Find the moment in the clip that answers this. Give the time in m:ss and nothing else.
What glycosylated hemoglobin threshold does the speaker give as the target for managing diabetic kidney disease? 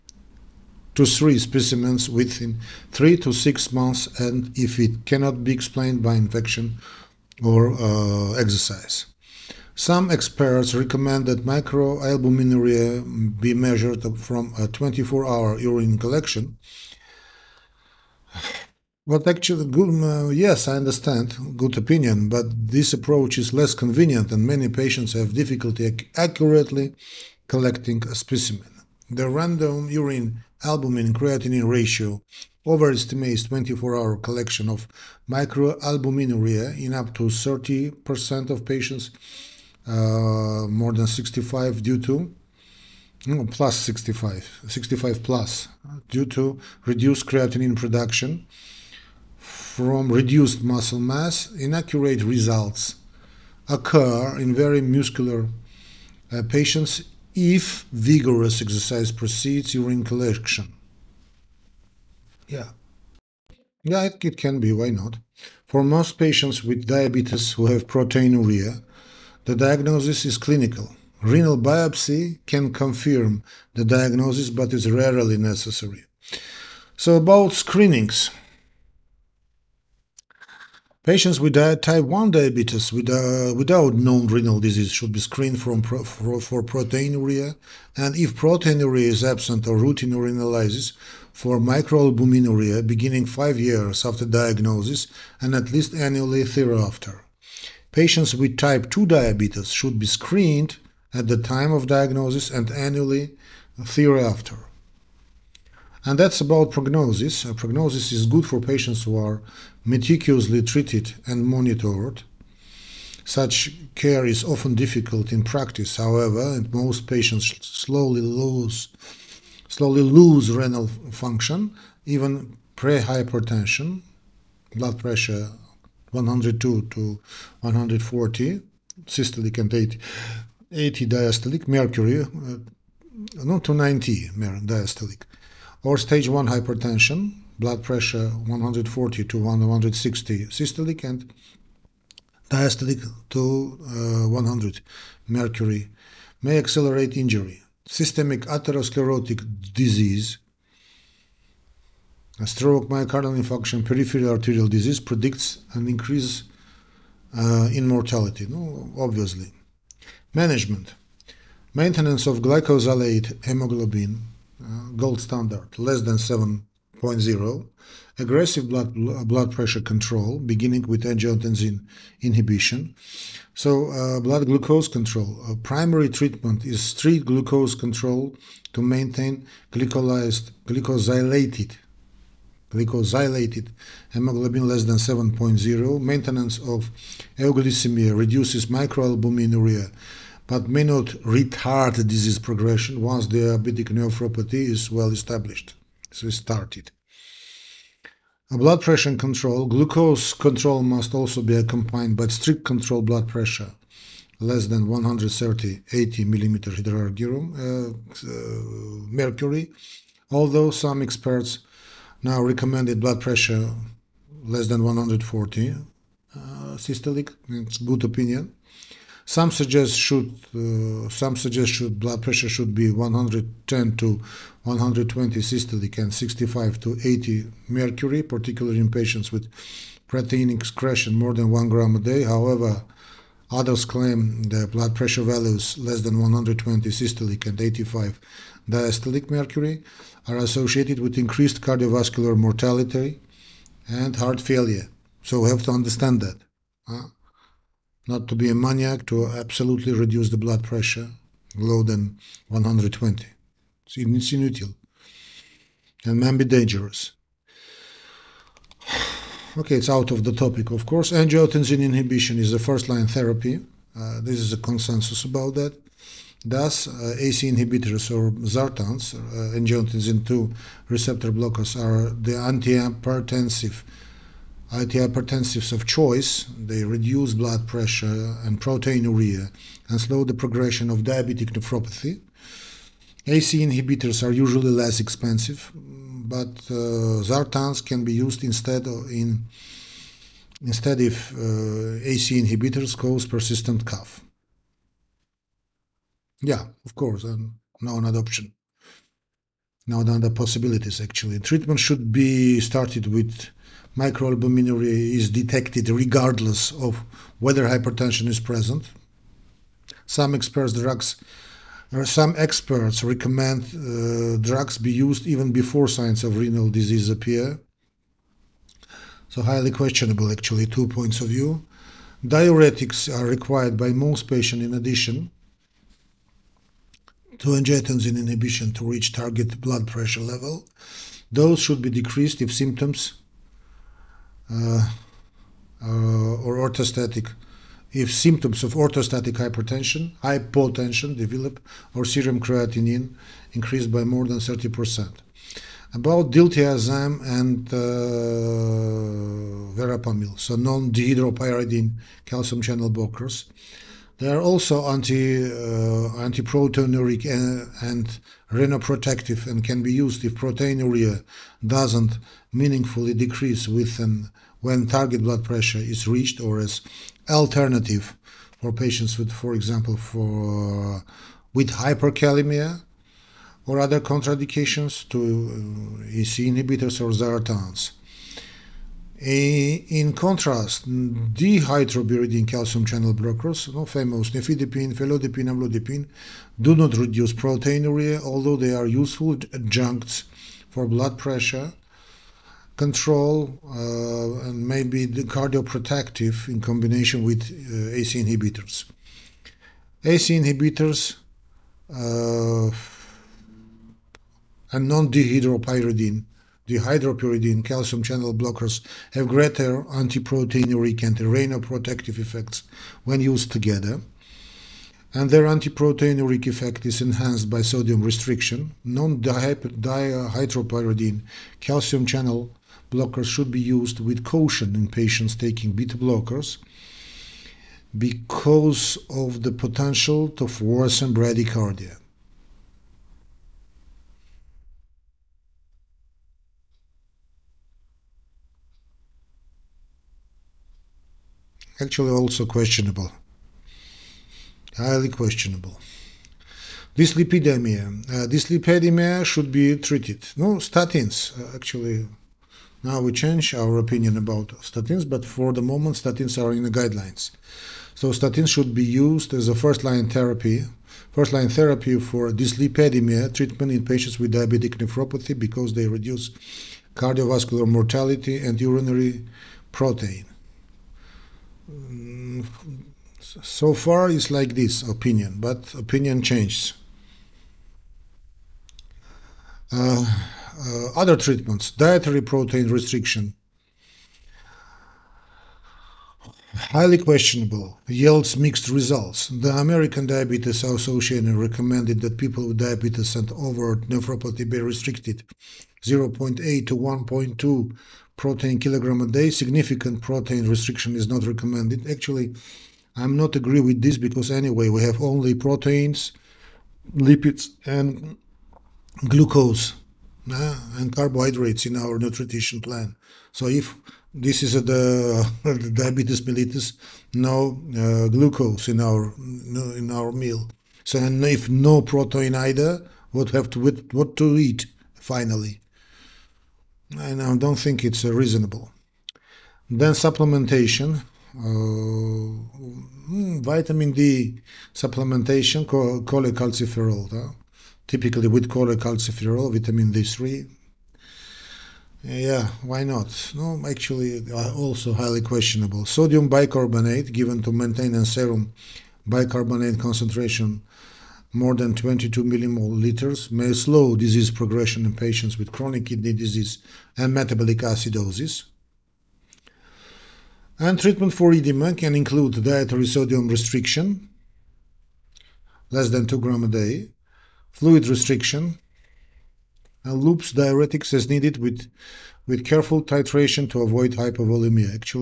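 3:04.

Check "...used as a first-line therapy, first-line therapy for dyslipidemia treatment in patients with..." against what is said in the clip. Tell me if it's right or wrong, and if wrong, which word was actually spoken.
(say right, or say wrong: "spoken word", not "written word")
right.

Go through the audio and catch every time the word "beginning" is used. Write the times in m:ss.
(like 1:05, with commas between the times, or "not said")
1:32, 2:50.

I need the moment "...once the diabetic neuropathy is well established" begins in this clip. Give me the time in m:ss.
3:13.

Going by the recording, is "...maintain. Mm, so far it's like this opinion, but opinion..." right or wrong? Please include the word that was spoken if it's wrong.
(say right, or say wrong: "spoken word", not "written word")
wrong: "protein", not "maintain".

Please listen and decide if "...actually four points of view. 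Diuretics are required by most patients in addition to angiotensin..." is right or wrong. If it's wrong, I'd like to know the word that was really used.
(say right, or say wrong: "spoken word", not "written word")
wrong: "two", not "four".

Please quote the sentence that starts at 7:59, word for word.
Uh, uh, other treatments, dietary protein restriction, highly questionable, yields mixed results.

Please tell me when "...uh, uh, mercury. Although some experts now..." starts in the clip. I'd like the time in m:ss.
3:27.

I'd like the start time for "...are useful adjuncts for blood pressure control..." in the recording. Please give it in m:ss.
6:28.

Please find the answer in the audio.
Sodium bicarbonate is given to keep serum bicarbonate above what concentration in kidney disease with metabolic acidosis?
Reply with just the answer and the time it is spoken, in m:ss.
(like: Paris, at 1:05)
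22 mmol/L, at 9:11.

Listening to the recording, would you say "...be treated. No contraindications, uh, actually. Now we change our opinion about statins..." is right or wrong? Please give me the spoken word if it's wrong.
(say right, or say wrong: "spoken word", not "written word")
wrong: "statins", not "contraindications".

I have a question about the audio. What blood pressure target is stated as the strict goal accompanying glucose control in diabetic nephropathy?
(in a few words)
less than 130/80.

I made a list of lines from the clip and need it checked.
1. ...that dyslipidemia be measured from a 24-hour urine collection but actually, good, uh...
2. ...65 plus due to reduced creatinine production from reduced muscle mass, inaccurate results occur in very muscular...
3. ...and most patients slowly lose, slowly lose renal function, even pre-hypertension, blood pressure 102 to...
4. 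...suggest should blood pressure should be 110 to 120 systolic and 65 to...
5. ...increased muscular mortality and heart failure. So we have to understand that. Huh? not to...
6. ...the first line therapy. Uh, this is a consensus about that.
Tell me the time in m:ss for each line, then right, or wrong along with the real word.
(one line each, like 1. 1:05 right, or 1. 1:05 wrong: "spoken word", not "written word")
1. 0:11 wrong: "microalbuminuria", not "dyslipidemia"
2. 0:44 right
3. 1:56 right
4. 3:41 right
5. 4:01 wrong: "cardiovascular", not "muscular"
6. 4:22 right.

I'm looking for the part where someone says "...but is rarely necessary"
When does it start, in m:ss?
1:14.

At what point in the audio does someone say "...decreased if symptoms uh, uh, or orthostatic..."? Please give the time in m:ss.
5:31.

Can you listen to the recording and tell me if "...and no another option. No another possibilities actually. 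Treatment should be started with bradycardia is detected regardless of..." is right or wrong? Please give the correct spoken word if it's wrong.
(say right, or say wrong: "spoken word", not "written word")
wrong: "microalbuminuria", not "bradycardia".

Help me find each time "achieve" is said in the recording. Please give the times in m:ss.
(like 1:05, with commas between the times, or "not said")
not said.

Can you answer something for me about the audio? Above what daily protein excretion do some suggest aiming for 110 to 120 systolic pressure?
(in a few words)
1 gram a day.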